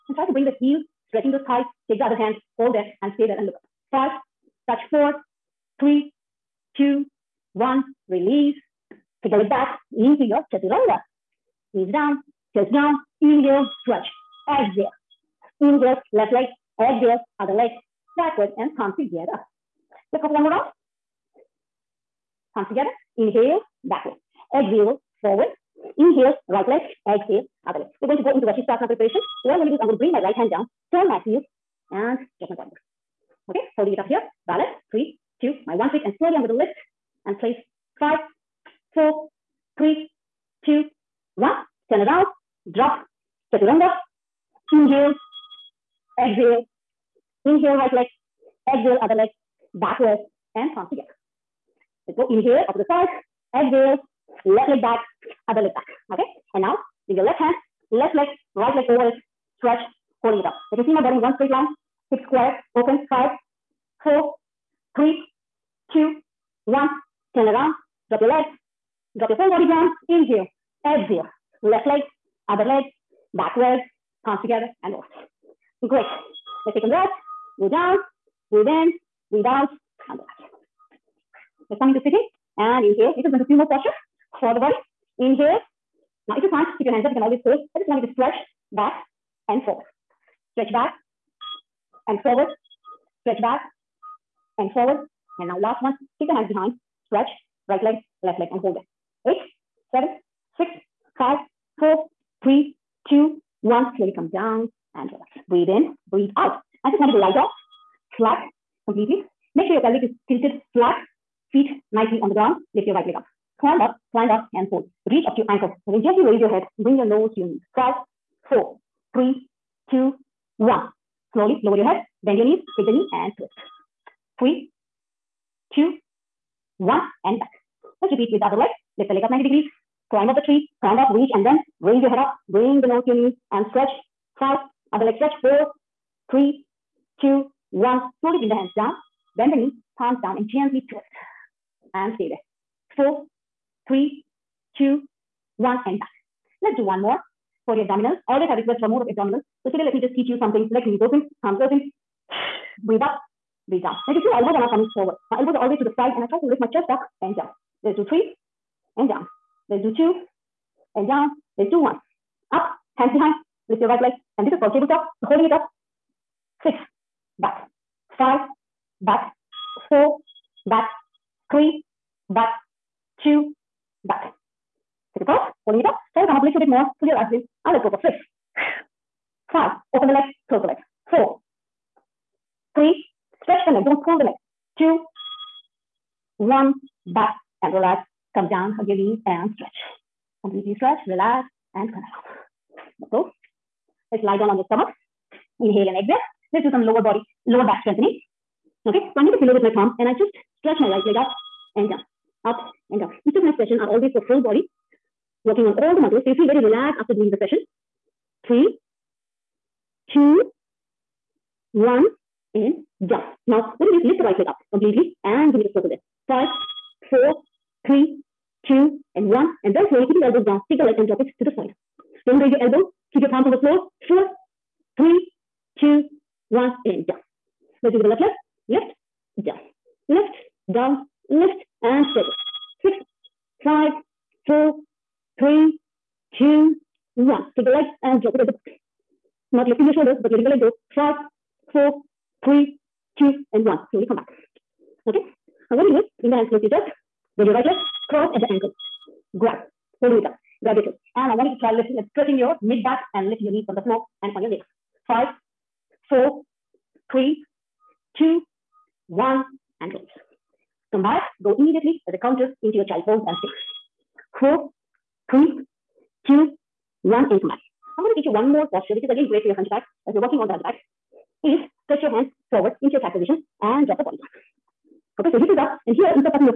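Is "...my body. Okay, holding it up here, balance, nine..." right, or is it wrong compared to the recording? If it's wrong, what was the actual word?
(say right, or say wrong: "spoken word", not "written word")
wrong: "three", not "nine".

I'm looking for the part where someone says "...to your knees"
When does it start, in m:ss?
1:57.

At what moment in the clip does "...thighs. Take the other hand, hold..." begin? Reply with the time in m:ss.
0:01.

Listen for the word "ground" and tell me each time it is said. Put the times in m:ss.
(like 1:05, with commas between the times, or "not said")
1:52.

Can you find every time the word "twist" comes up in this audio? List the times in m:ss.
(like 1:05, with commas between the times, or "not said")
2:03, 2:20.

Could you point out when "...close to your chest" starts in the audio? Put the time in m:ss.
4:06.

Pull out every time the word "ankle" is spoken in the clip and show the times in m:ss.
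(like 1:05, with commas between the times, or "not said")
1:55, 4:08.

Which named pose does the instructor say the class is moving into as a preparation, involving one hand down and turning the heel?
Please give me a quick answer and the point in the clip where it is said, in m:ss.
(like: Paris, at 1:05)
Vashisthasana, at 0:28.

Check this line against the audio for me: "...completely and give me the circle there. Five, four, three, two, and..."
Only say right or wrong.
right.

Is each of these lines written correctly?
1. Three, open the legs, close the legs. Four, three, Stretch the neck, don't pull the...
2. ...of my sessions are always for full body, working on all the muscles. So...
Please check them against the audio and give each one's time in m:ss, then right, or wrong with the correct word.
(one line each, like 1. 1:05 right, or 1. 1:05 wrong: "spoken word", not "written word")
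1. 2:59 wrong: "Five", not "Three"
2. 3:23 right.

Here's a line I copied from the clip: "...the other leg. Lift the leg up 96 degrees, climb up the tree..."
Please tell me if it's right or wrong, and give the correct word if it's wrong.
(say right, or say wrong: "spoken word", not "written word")
wrong: "90", not "96".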